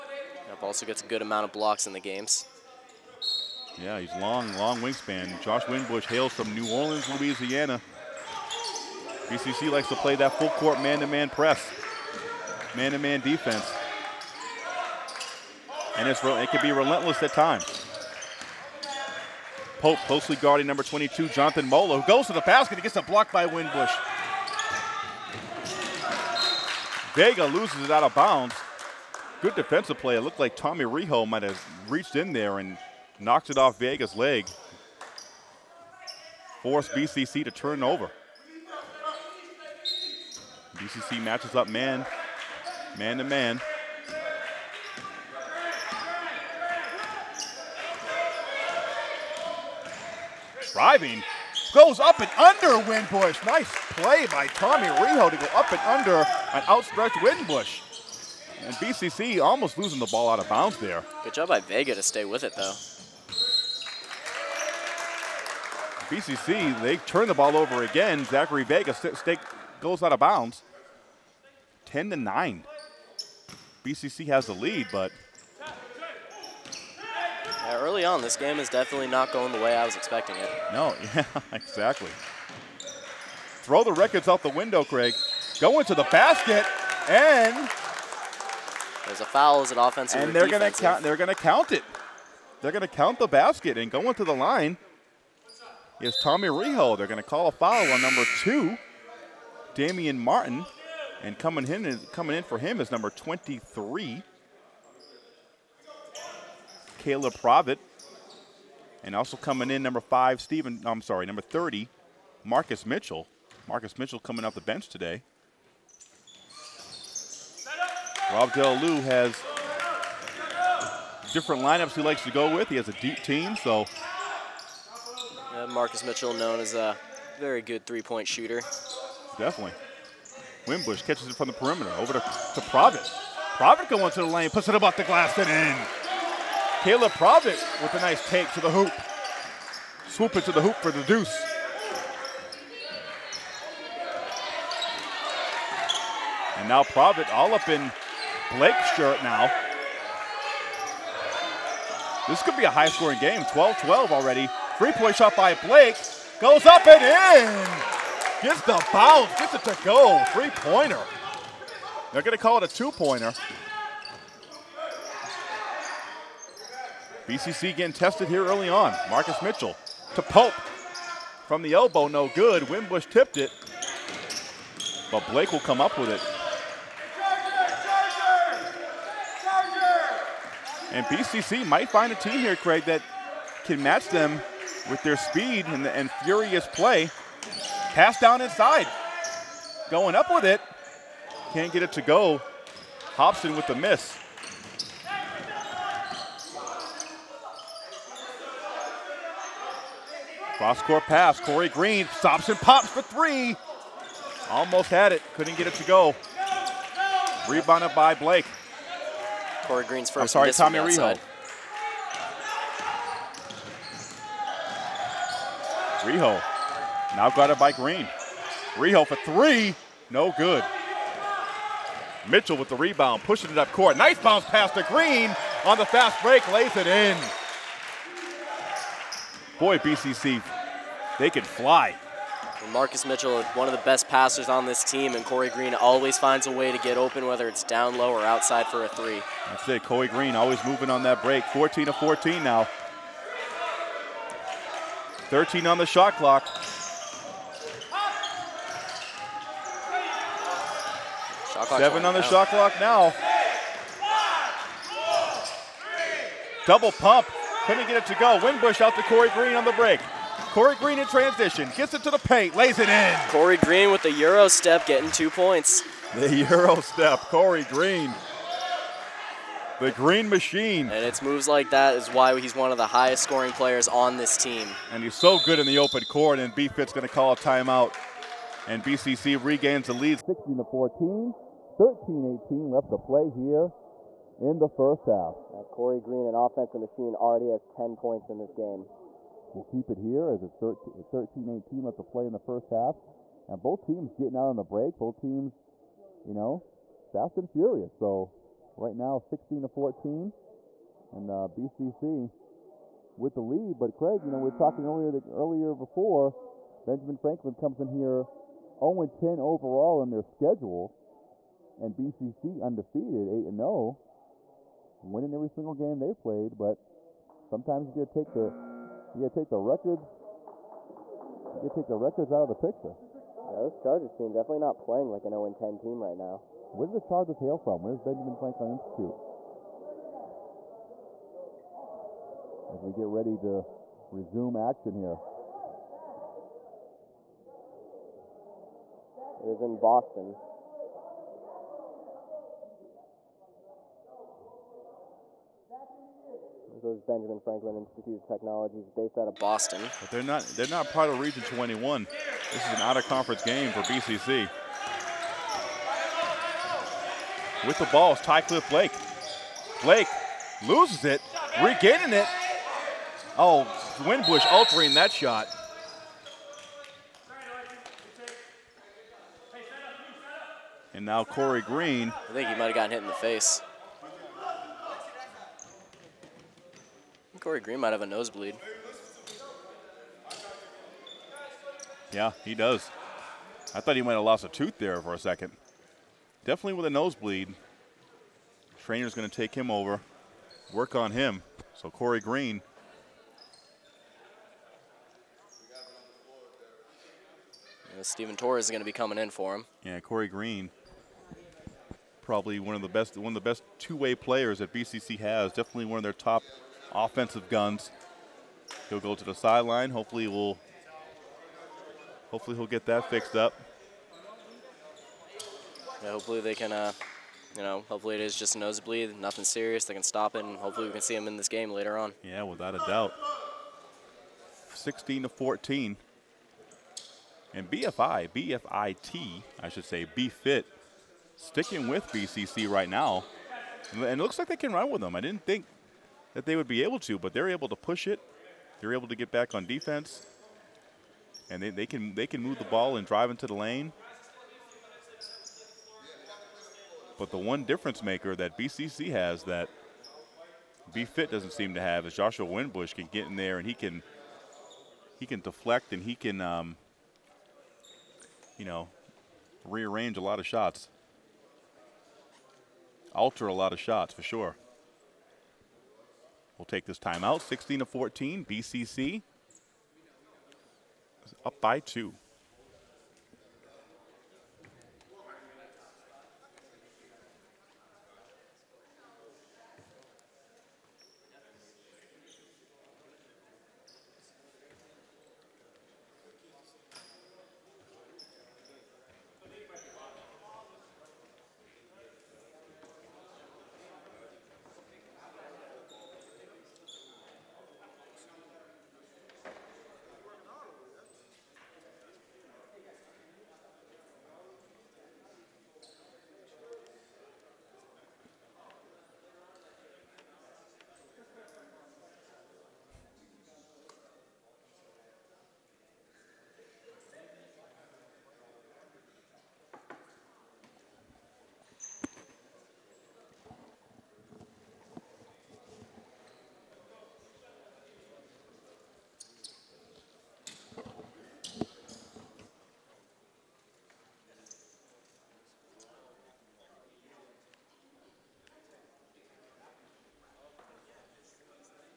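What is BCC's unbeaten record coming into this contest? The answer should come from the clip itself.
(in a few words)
8-0.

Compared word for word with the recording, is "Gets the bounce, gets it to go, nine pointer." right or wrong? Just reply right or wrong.
wrong.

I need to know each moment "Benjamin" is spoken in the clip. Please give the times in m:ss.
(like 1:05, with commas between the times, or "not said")
5:06, 5:28, 5:47.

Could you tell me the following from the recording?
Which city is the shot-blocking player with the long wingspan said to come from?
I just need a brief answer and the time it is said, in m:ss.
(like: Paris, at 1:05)
New Orleans, at 0:06.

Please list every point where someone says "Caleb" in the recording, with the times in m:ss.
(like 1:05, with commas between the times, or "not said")
1:47, 2:16.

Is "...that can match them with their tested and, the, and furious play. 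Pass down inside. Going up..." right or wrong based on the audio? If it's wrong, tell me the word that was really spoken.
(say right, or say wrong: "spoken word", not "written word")
wrong: "speed", not "tested".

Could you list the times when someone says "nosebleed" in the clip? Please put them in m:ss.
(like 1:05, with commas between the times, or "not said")
6:18, 6:26, 6:58.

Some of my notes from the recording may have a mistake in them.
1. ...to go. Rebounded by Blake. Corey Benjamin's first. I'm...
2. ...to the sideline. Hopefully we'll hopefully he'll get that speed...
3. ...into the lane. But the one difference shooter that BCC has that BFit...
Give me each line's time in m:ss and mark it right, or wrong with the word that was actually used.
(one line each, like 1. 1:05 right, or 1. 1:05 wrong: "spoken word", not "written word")
1. 3:25 wrong: "Green", not "Benjamin"
2. 6:49 wrong: "fixed", not "speed"
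3. 7:23 wrong: "maker", not "shooter".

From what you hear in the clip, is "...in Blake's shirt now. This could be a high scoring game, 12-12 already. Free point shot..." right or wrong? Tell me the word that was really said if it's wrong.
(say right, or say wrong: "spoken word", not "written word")
right.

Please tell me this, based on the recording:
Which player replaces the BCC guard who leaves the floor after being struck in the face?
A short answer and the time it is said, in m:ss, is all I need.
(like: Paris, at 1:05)
Steven Torres, at 6:38.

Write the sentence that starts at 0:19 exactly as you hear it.
Pope closely guarding number 22, Jonathan Mola, who goes to the basket and gets a block by Winbush.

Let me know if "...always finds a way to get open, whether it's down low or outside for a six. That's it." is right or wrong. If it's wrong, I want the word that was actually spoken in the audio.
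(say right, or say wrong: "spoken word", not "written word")
wrong: "three", not "six".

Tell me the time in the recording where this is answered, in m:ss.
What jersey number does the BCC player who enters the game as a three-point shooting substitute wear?
1:51.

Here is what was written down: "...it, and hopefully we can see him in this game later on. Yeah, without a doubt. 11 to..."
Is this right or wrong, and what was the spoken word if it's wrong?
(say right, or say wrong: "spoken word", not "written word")
wrong: "16", not "11".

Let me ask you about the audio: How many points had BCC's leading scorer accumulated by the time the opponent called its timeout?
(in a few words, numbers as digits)
10.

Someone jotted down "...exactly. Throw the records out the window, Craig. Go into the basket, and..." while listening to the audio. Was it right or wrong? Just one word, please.
right.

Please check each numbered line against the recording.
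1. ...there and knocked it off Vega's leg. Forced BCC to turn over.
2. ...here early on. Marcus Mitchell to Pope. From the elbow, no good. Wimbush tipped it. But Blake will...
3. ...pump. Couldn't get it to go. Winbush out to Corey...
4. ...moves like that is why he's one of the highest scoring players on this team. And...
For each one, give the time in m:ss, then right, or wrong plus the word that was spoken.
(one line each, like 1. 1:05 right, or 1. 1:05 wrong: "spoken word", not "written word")
1. 0:32 right
2. 2:48 right
3. 4:16 right
4. 4:31 right.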